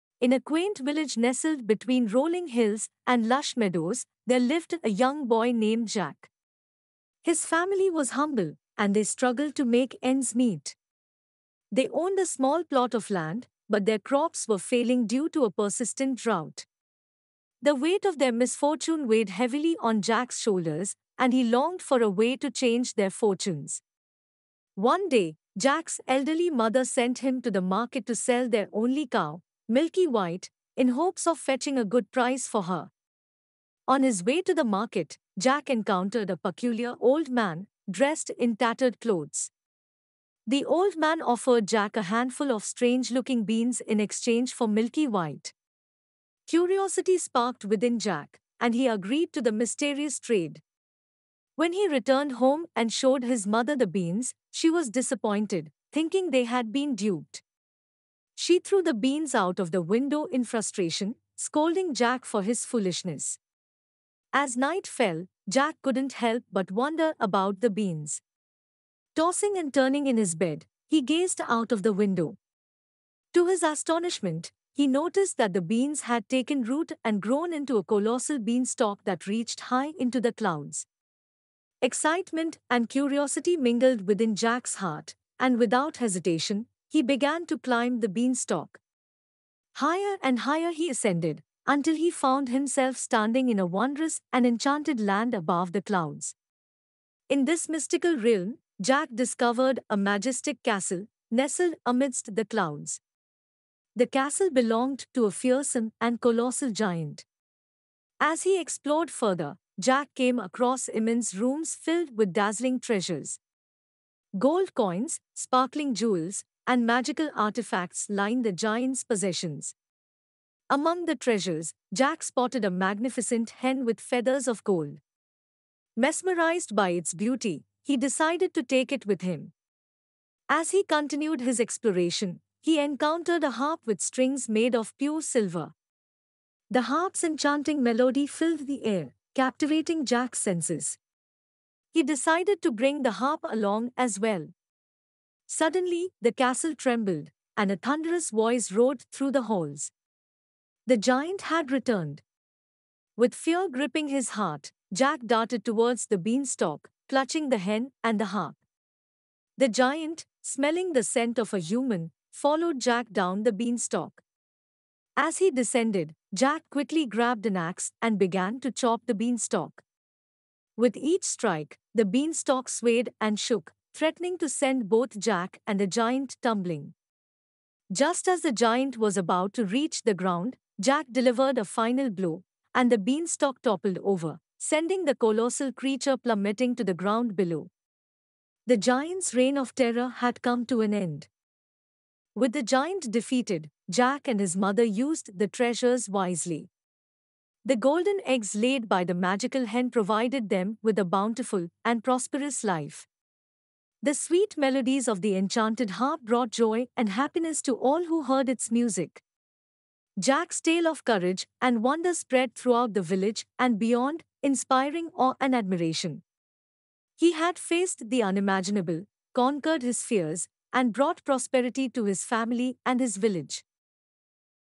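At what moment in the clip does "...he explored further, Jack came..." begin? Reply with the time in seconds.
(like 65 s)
108 s.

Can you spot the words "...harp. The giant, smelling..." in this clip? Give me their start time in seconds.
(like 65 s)
158 s.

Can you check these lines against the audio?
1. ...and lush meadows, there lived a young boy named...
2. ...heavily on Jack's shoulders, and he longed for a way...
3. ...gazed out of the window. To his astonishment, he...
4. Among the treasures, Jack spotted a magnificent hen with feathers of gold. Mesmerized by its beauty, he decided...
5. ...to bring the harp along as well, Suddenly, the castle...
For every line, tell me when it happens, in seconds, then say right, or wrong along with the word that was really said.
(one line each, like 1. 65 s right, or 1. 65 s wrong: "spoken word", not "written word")
1. 3 s right
2. 19 s right
3. 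71 s right
4. 120 s right
5. 142 s right.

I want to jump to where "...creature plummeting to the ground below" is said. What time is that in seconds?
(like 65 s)
185 s.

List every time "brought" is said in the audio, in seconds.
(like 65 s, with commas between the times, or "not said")
206 s, 220 s.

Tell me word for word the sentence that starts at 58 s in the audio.
She threw the beans out of the window in frustration, scolding Jack for his foolishness.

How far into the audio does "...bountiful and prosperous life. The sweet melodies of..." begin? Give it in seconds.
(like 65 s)
201 s.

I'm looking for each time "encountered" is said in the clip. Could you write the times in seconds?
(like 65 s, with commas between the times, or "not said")
35 s, 132 s.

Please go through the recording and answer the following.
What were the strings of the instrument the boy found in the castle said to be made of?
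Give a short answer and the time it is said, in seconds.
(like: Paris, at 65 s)
pure silver, at 134 s.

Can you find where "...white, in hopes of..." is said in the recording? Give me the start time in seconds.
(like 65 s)
30 s.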